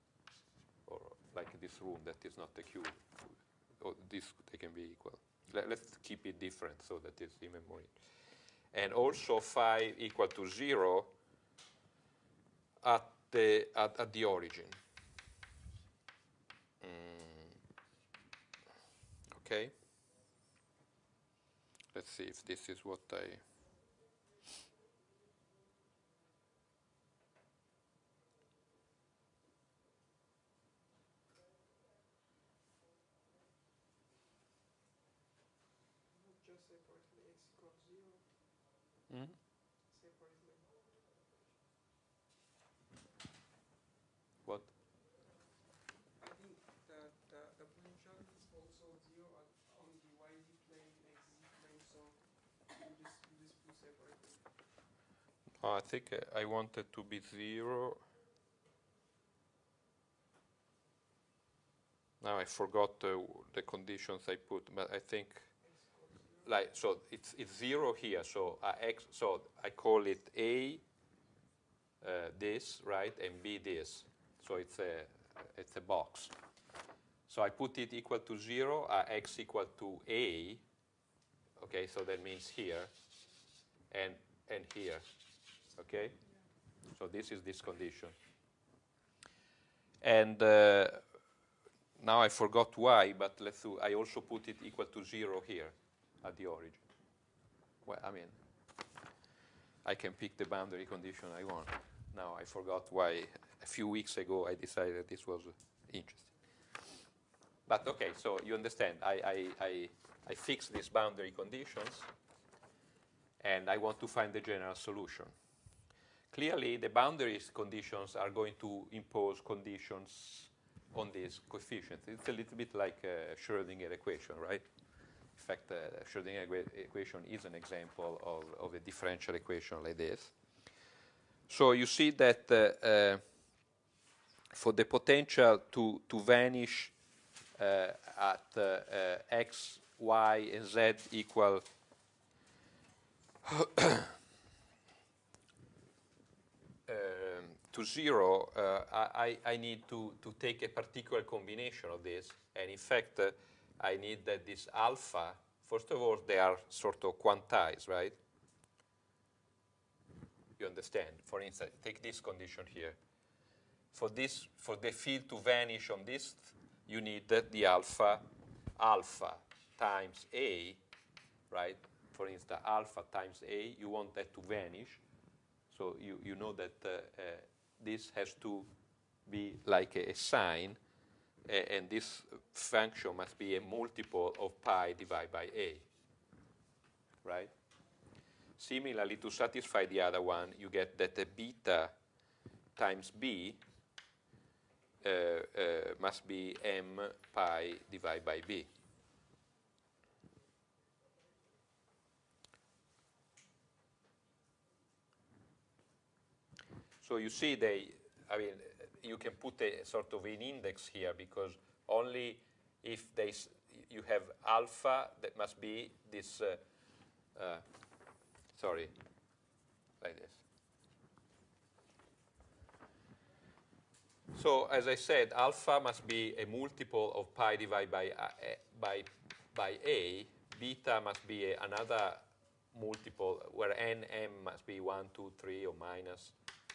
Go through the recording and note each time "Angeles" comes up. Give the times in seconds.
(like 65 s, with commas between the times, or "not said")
not said.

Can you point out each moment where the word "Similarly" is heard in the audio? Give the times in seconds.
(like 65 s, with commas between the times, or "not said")
188 s.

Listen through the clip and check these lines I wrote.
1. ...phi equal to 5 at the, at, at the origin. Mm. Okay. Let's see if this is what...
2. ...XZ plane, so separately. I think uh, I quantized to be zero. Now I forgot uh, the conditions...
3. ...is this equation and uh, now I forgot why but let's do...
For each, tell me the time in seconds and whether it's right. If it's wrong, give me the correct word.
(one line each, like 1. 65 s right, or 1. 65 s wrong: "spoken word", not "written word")
1. 9 s wrong: "0", not "5"
2. 50 s wrong: "wanted", not "quantized"
3. 87 s wrong: "condition", not "equation".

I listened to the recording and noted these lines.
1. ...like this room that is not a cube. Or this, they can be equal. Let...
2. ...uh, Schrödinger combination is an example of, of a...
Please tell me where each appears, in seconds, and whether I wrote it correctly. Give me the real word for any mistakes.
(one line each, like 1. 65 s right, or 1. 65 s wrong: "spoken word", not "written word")
1. 1 s right
2. 125 s wrong: "equation", not "combination".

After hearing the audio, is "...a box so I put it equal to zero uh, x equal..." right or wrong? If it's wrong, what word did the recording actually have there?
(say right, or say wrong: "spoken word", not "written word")
right.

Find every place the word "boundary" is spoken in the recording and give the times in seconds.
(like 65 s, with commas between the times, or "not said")
100 s, 110 s, 116 s.